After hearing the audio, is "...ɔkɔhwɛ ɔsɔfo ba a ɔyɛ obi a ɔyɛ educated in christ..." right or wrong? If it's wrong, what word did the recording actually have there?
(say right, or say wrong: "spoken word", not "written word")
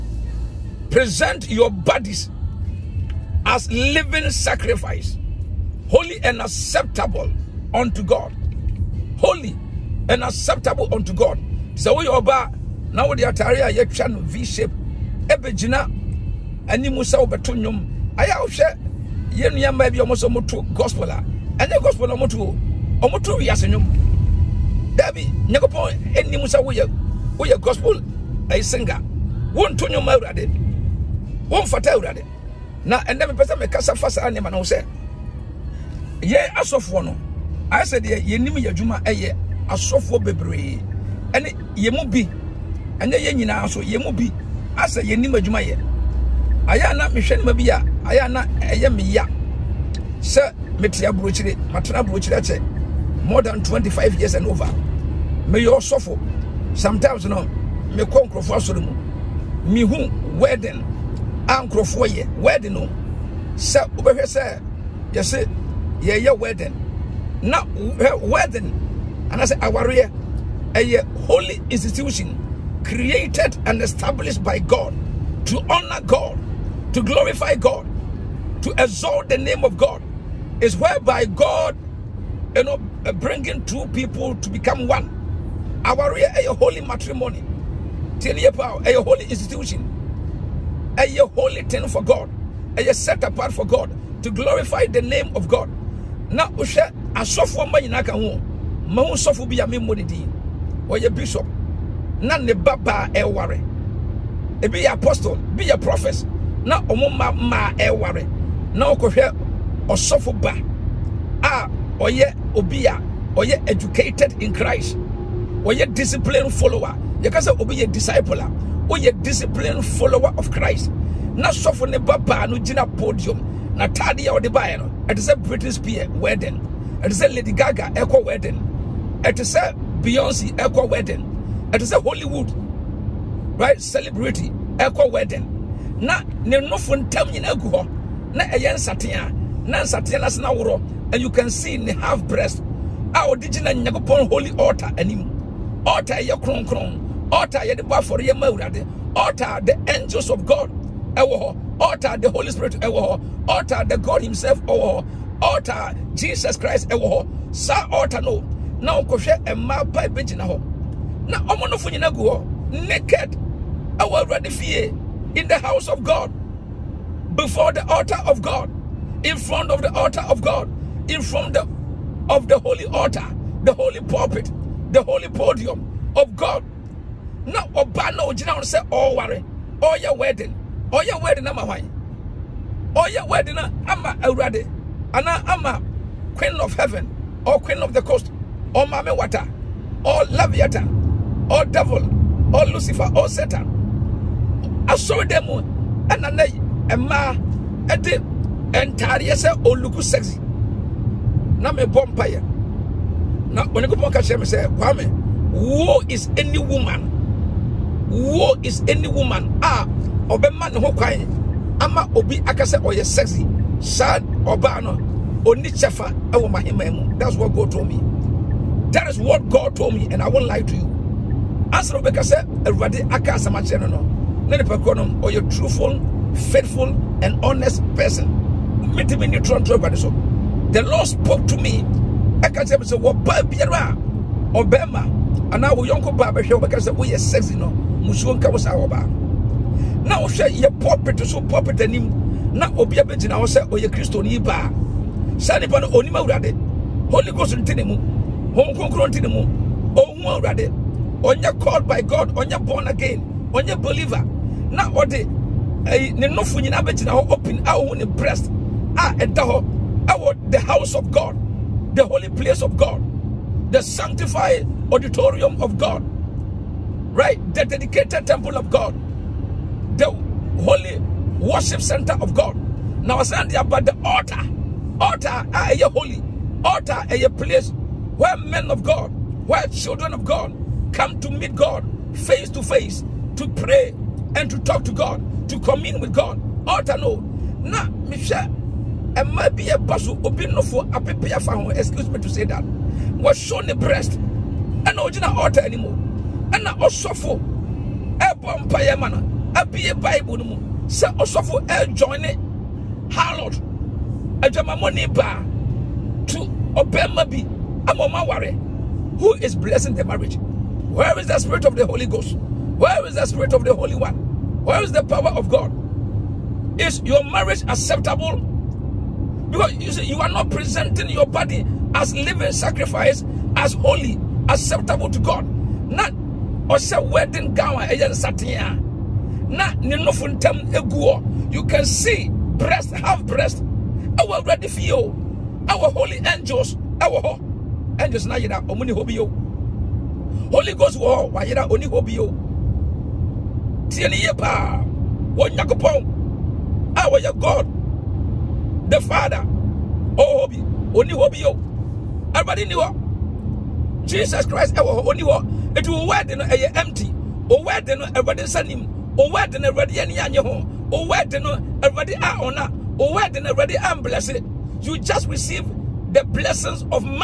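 right.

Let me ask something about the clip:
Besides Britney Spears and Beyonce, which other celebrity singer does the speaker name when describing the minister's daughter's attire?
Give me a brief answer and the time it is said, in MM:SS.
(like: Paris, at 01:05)
Lady Gaga, at 02:07.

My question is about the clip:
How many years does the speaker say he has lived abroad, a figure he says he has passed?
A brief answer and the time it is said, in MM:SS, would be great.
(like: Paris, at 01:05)
25, at 00:53.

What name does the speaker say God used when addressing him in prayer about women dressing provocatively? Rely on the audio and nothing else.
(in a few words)
Kwame.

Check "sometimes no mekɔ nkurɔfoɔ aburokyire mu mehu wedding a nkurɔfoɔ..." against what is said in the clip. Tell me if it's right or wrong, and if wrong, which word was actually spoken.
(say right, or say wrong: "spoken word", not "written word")
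wrong: "asɔre", not "aburokyire".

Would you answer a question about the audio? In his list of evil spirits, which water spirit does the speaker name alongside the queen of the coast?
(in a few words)
Mame Water.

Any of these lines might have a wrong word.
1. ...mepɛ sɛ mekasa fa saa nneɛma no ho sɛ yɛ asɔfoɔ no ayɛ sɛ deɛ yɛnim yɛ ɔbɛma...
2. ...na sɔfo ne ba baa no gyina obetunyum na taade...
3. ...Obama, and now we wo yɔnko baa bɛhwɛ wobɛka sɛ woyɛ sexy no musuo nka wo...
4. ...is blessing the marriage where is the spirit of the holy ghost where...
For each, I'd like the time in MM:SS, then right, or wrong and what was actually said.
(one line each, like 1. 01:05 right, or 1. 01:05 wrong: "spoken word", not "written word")
1. 00:33 wrong: "adwuma", not "ɔbɛma"
2. 02:01 wrong: "podium", not "obetunyum"
3. 03:54 right
4. 05:09 right.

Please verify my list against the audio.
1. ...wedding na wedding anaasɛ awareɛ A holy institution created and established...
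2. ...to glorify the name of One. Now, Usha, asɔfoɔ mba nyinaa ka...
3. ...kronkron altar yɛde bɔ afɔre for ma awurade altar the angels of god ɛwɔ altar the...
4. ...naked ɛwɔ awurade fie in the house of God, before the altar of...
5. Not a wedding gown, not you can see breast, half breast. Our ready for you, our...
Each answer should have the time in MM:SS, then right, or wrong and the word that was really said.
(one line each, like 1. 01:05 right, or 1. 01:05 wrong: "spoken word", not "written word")
1. 01:06 right
2. 01:34 wrong: "God", not "One"
3. 02:26 right
4. 02:42 right
5. 05:25 right.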